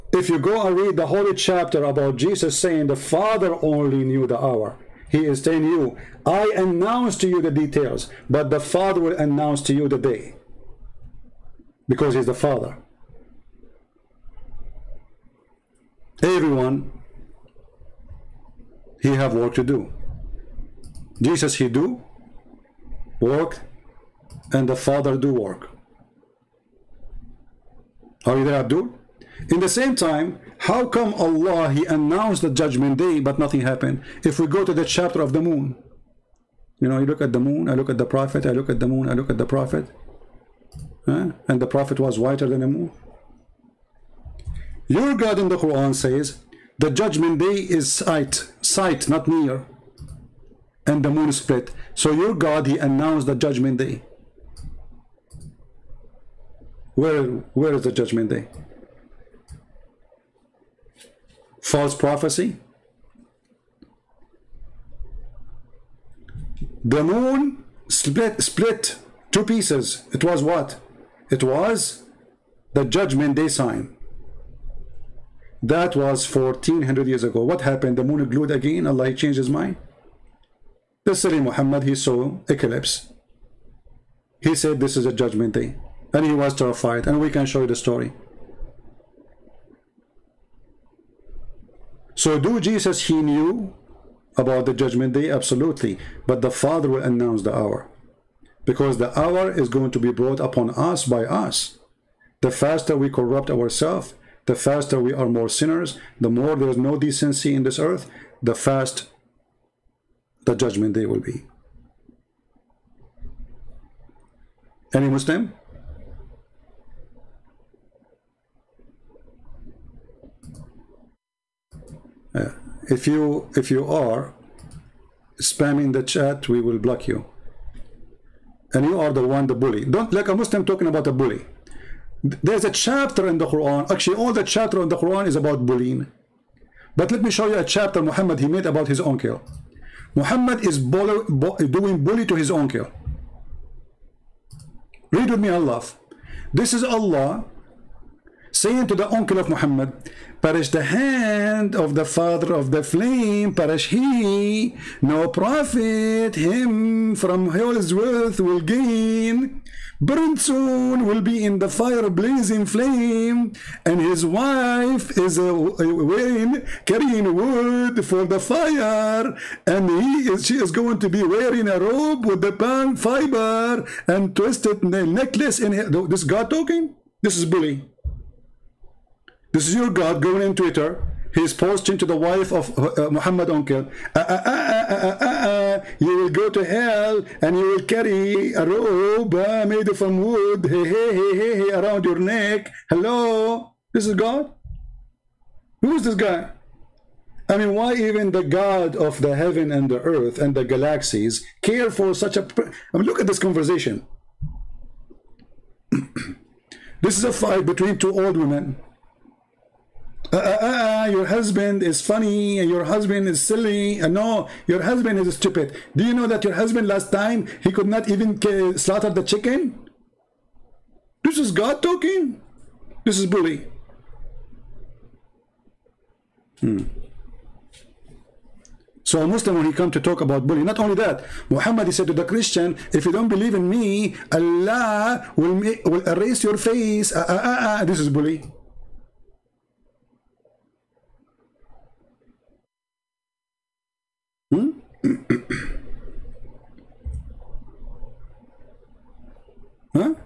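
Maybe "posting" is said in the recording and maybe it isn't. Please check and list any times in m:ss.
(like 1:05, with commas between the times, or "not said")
3:01.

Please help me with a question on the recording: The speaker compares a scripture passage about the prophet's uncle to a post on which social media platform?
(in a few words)
Twitter.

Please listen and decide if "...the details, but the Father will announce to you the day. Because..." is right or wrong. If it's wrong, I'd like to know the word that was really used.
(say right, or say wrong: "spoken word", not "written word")
right.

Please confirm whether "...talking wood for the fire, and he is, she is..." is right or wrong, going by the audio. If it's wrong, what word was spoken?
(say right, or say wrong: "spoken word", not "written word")
wrong: "carrying", not "talking".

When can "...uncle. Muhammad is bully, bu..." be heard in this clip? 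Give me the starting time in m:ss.
2:19.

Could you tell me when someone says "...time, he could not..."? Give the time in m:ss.
3:37.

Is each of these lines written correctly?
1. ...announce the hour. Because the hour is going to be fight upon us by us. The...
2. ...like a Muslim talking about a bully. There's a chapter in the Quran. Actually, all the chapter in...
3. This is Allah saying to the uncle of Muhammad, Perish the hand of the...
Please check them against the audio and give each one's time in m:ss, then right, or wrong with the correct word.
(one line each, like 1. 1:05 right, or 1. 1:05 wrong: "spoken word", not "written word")
1. 1:37 wrong: "brought", not "fight"
2. 2:10 right
3. 2:26 right.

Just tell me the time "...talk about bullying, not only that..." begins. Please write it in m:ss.
3:50.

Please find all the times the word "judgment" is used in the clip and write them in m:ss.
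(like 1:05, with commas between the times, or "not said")
0:32, 0:46, 0:53, 0:57, 1:12, 1:25, 1:34, 1:50.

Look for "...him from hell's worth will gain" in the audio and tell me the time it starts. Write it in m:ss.
2:36.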